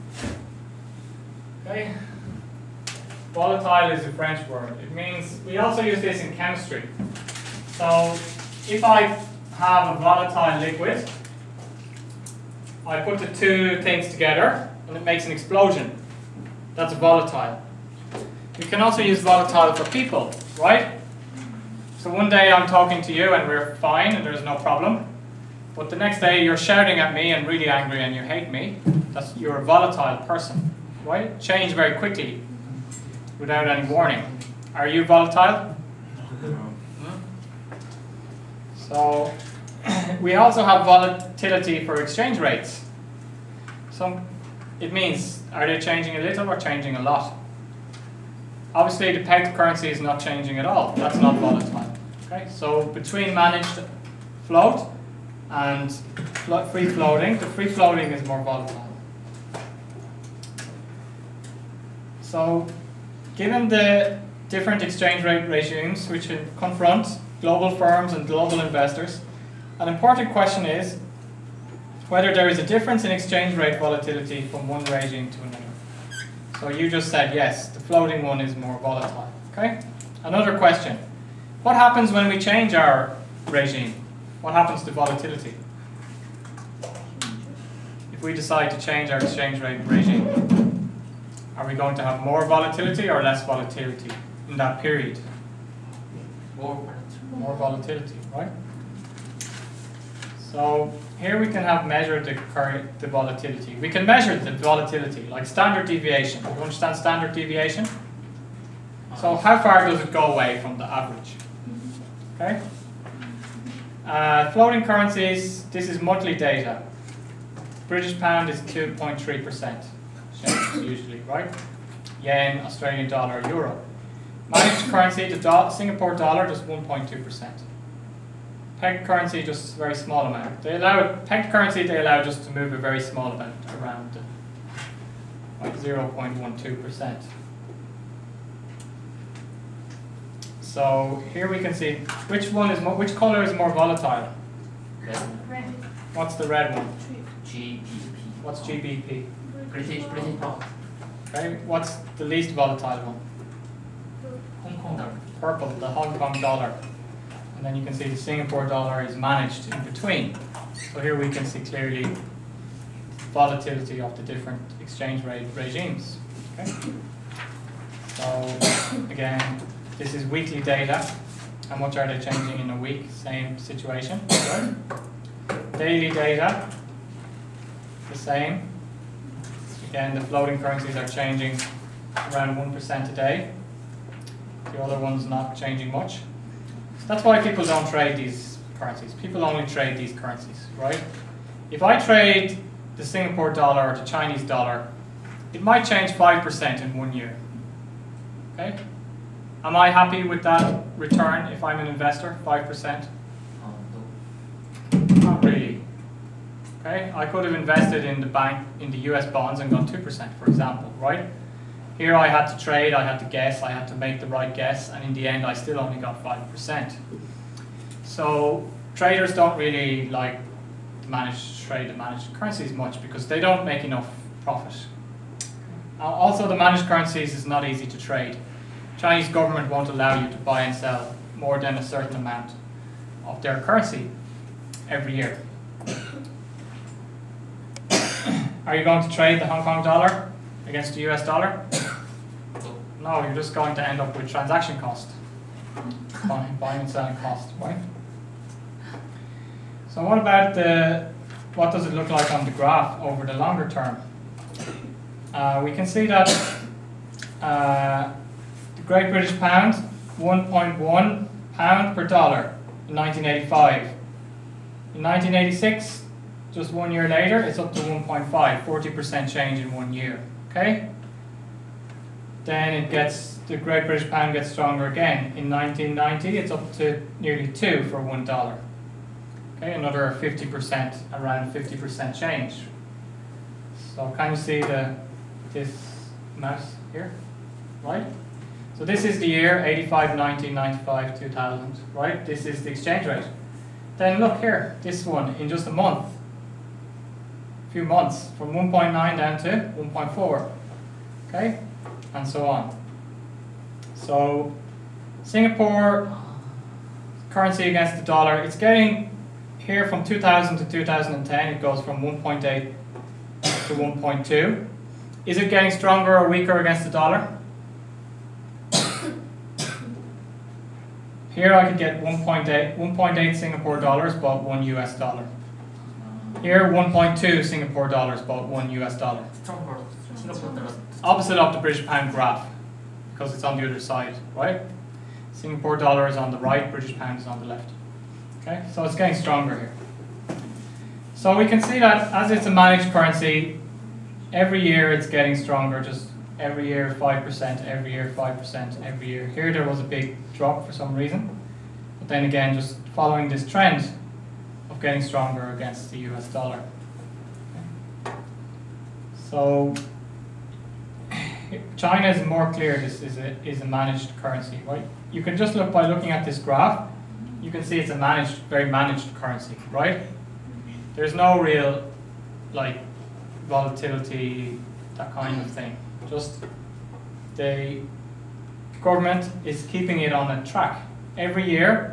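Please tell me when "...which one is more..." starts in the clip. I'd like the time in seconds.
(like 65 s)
142 s.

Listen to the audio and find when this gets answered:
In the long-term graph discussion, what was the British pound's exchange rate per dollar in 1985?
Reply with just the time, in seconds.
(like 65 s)
260 s.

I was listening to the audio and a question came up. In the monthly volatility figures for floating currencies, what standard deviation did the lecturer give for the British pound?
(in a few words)
2.3%.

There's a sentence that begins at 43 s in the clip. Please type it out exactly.
So it means, are they changing a little or changing a lot?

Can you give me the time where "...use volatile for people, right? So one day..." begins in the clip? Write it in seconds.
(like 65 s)
19 s.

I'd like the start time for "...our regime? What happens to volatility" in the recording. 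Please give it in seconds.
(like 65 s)
82 s.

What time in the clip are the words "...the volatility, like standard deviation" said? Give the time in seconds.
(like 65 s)
104 s.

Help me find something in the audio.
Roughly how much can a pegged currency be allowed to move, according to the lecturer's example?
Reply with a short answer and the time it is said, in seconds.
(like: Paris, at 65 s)
0.12%, at 135 s.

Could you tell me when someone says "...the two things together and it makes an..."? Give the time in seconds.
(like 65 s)
13 s.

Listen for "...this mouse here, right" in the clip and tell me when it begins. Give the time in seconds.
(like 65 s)
285 s.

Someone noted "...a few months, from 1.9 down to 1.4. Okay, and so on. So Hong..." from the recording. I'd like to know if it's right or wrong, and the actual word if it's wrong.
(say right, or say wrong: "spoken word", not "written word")
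wrong: "Singapore", not "Hong".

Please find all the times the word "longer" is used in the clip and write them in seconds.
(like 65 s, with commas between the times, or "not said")
253 s.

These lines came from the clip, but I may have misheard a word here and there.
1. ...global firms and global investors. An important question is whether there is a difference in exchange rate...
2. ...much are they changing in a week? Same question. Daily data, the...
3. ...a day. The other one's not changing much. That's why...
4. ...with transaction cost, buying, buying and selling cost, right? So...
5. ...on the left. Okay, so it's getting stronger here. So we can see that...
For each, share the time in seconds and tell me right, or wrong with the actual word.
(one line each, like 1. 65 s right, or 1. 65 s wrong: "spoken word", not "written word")
1. 67 s right
2. 171 s wrong: "situation", not "question"
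3. 183 s right
4. 244 s right
5. 337 s right.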